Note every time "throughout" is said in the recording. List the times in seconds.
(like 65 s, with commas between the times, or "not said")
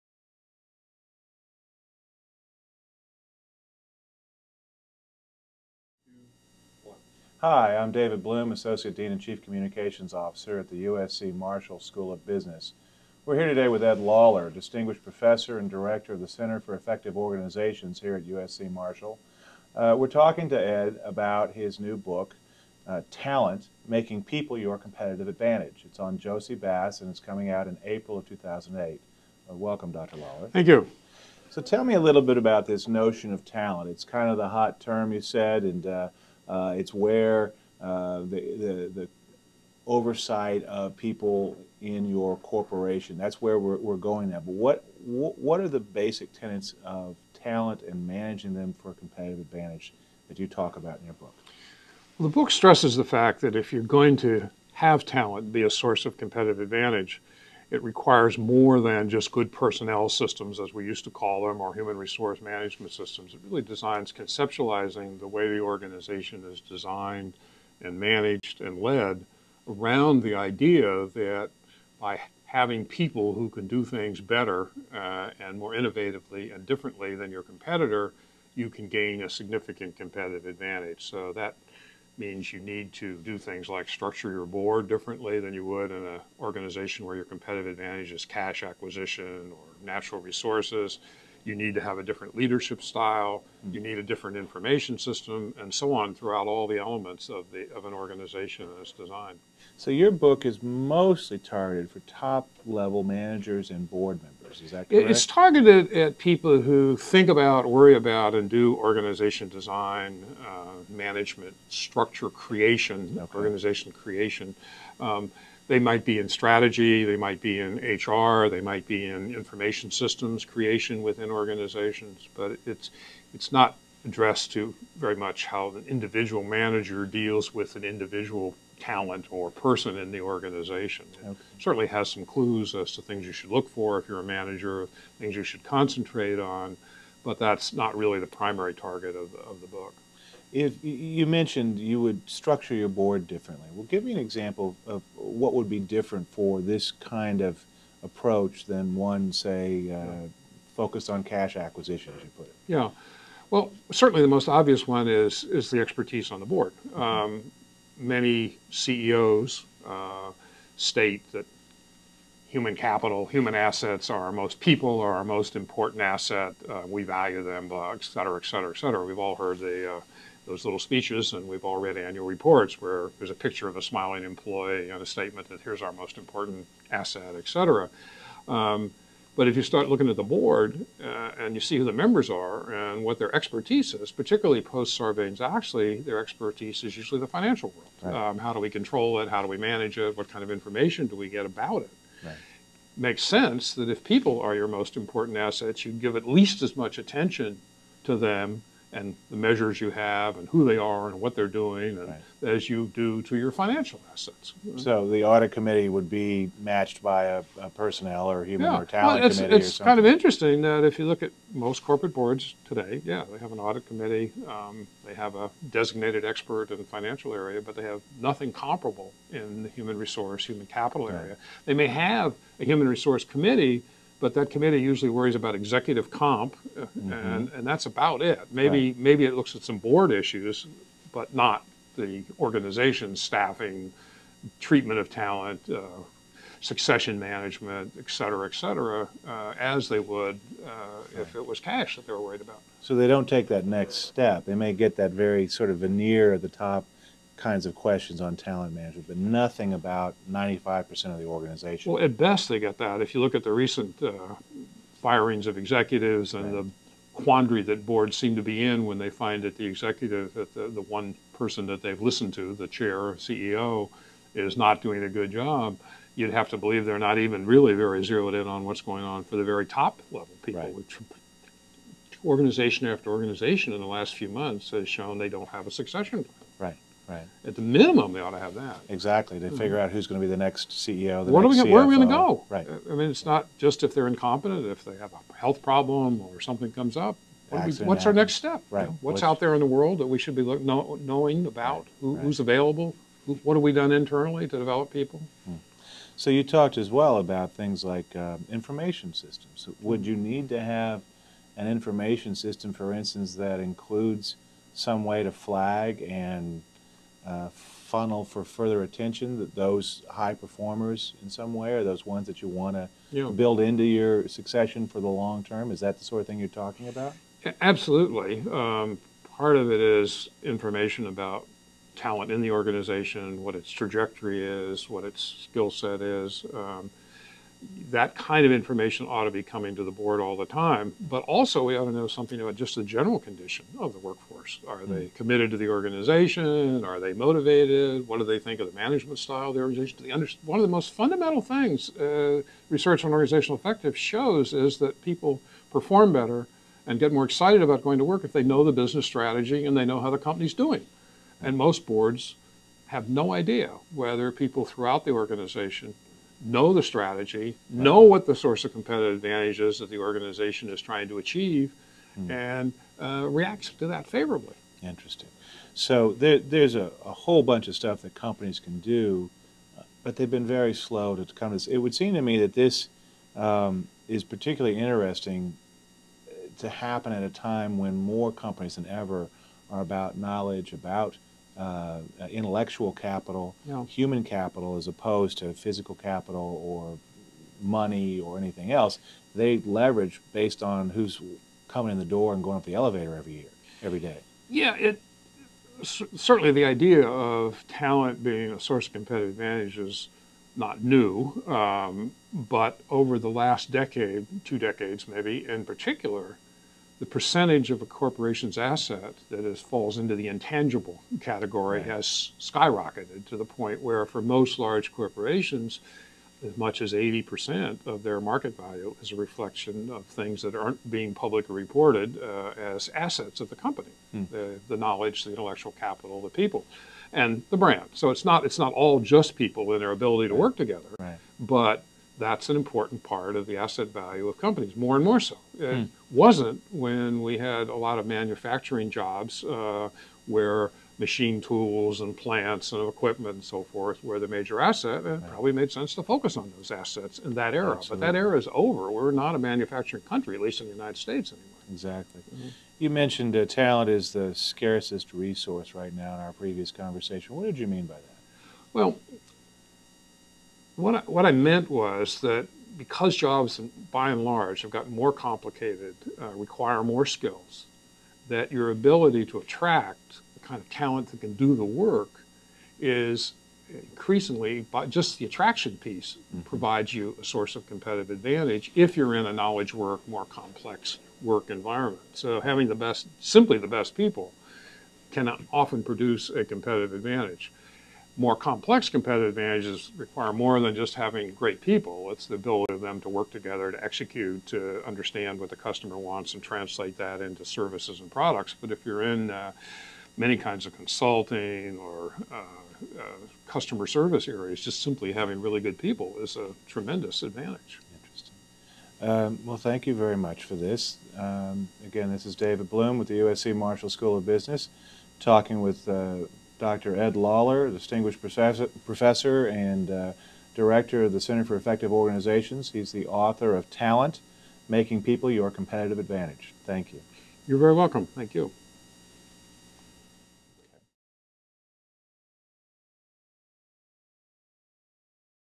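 96 s, 354 s.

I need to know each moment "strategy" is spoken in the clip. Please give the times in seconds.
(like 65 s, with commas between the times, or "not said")
116 s, 349 s, 356 s.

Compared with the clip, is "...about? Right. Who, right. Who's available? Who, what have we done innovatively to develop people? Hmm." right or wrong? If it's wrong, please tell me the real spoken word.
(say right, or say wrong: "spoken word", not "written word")
wrong: "internally", not "innovatively".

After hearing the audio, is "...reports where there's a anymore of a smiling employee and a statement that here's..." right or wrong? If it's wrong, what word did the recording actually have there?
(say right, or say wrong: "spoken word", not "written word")
wrong: "picture", not "anymore".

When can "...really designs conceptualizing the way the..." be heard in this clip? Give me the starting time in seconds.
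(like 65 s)
63 s.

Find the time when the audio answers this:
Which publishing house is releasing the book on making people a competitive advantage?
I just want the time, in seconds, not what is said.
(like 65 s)
26 s.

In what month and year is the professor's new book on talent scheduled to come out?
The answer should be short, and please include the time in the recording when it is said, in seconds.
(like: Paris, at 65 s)
April 2008, at 27 s.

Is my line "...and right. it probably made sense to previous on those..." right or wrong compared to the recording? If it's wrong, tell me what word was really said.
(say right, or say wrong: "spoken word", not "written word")
wrong: "focus", not "previous".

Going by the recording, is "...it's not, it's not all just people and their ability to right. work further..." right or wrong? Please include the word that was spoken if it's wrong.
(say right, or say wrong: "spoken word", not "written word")
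wrong: "together", not "further".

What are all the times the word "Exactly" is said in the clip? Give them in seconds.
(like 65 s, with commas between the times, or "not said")
278 s, 451 s.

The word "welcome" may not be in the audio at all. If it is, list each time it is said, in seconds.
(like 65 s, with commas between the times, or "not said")
29 s, 527 s.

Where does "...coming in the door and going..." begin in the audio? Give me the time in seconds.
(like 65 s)
391 s.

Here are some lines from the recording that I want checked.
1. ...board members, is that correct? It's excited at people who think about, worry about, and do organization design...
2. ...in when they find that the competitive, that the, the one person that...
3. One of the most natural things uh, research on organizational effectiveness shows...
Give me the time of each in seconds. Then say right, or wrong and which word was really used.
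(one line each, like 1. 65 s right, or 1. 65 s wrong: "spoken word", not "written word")
1. 103 s wrong: "targeted", not "excited"
2. 258 s wrong: "executive", not "competitive"
3. 340 s wrong: "fundamental", not "natural".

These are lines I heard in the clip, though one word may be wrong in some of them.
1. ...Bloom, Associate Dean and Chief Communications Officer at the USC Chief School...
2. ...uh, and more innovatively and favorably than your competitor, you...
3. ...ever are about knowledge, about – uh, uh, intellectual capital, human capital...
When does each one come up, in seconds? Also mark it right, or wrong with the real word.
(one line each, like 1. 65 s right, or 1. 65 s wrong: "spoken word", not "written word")
1. 8 s wrong: "Marshall", not "Chief"
2. 74 s wrong: "differently", not "favorably"
3. 378 s right.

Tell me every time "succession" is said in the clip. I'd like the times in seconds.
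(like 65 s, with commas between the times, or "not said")
236 s, 275 s, 314 s.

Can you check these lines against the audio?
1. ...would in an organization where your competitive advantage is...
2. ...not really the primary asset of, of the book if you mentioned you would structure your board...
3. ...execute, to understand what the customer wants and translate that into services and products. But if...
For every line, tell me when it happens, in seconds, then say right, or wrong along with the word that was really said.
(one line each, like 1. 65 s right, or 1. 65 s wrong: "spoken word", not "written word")
1. 85 s right
2. 137 s wrong: "target", not "asset"
3. 493 s right.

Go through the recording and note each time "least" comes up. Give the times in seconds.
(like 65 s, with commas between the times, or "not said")
196 s, 450 s.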